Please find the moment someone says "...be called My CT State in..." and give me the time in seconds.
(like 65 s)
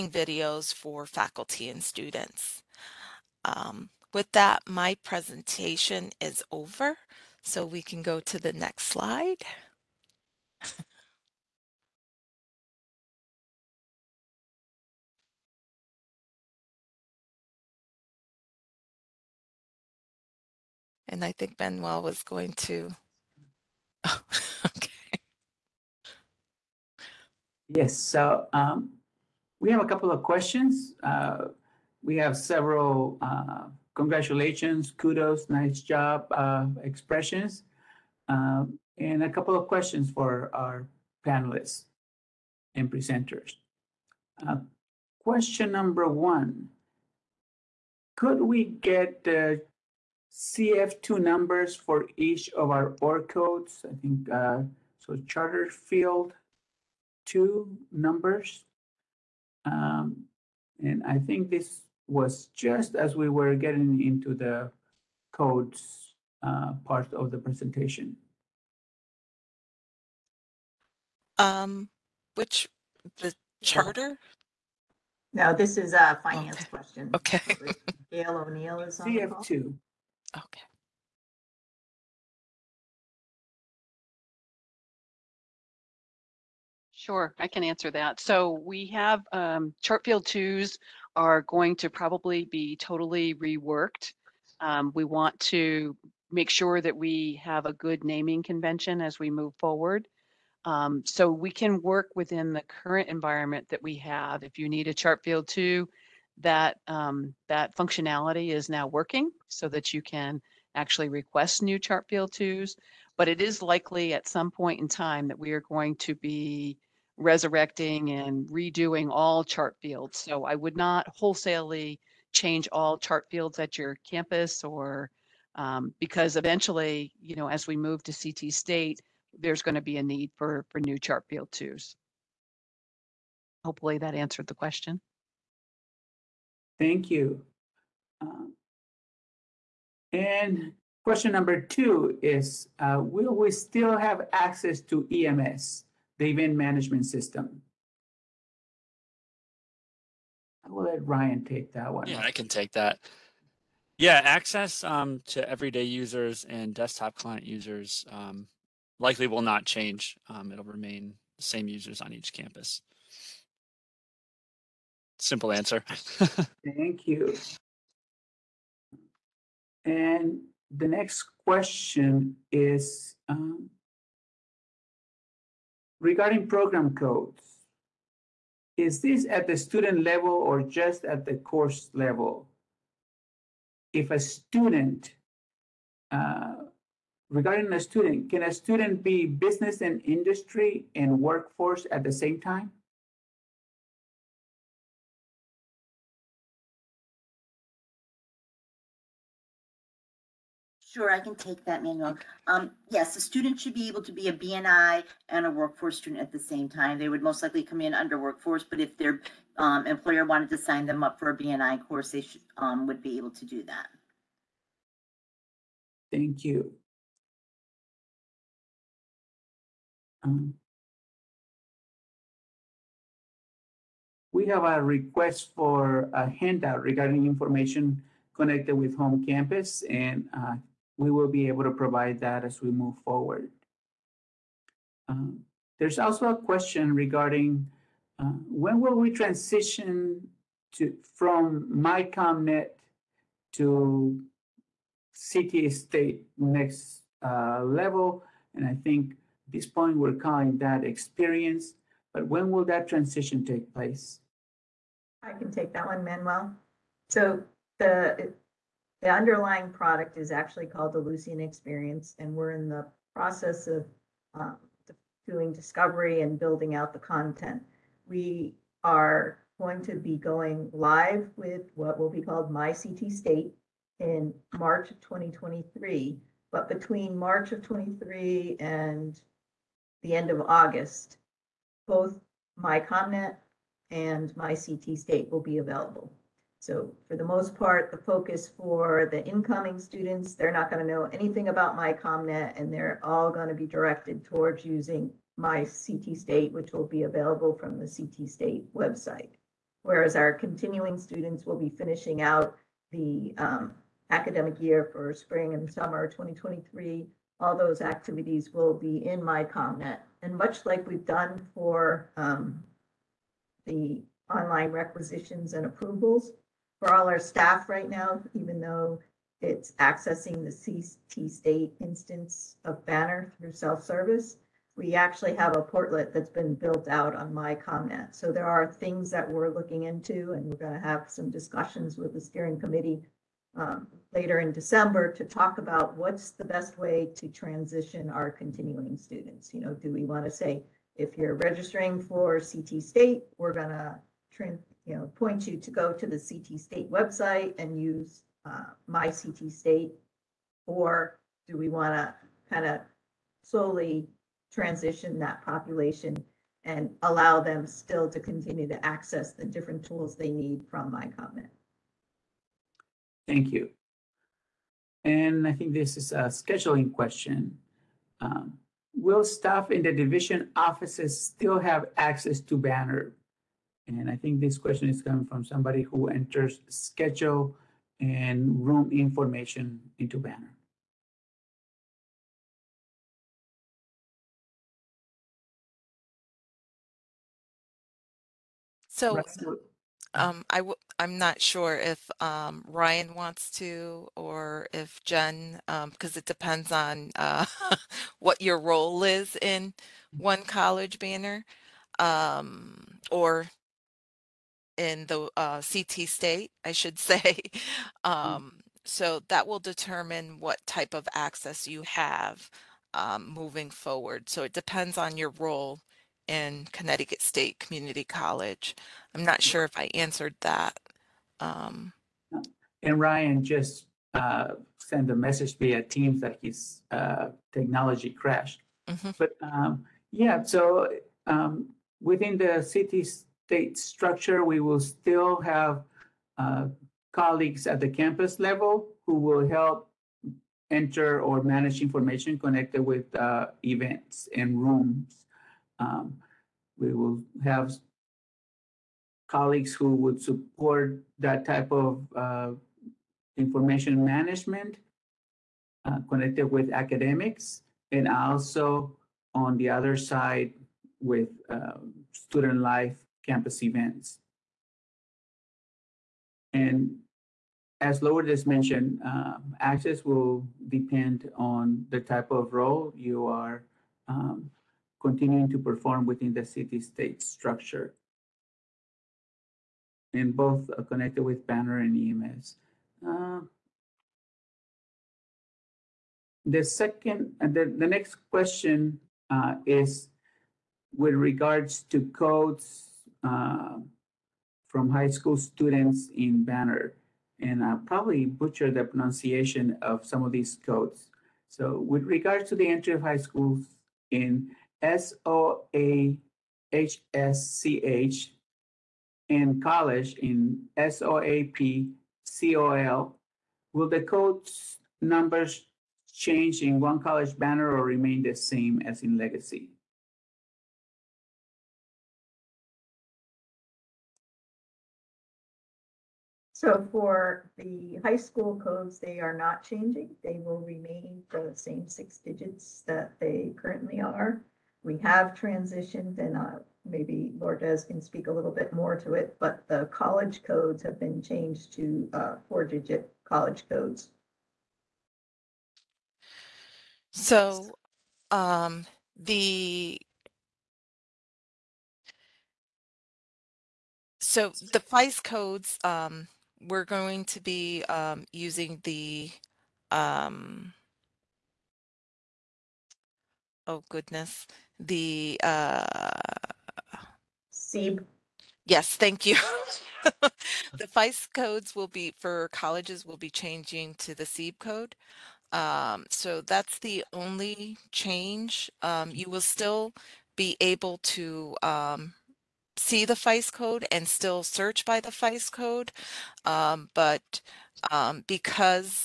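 272 s.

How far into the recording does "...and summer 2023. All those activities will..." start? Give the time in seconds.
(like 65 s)
305 s.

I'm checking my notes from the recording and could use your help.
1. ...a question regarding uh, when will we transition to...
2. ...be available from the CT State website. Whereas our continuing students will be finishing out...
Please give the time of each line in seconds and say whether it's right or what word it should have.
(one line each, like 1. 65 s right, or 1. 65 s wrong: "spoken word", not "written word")
1. 236 s right
2. 296 s right.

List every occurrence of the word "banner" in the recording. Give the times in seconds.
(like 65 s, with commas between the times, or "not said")
322 s, 372 s, 380 s, 400 s, 481 s, 496 s, 517 s.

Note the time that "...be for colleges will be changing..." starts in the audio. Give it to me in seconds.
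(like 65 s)
571 s.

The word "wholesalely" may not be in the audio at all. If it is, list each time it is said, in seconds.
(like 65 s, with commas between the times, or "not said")
121 s.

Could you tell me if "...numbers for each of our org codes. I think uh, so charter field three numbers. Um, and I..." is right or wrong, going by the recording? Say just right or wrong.
wrong.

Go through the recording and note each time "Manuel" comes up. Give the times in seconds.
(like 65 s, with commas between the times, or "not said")
21 s, 201 s, 256 s.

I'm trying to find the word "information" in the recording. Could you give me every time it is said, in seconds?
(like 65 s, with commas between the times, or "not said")
227 s, 378 s, 441 s, 453 s.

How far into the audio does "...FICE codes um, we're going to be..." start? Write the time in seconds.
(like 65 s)
554 s.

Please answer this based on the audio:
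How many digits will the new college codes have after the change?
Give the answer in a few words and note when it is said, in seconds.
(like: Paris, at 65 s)
4, at 542 s.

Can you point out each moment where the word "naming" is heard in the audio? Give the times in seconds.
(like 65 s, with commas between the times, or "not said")
98 s.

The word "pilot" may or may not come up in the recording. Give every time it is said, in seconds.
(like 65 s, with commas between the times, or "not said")
not said.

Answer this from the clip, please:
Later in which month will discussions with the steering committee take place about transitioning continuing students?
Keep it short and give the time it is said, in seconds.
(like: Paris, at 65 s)
December, at 334 s.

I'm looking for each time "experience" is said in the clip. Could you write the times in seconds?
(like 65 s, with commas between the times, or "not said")
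250 s, 261 s.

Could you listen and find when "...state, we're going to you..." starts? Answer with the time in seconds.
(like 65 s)
342 s.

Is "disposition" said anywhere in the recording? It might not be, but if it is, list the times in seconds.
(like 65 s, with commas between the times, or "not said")
not said.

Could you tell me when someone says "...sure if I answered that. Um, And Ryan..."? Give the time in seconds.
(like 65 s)
419 s.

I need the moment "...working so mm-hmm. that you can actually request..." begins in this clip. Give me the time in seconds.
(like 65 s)
108 s.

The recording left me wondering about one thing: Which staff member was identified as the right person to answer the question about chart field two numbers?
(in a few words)
Gail O'Neill.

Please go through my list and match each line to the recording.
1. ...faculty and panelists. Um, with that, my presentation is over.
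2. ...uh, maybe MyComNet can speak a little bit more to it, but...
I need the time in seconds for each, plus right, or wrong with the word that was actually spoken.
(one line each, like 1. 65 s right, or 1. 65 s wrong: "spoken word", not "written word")
1. 1 s wrong: "students", not "panelists"
2. 536 s wrong: "Lourdes", not "MyComNet".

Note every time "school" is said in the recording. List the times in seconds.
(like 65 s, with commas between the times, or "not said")
495 s, 503 s, 528 s.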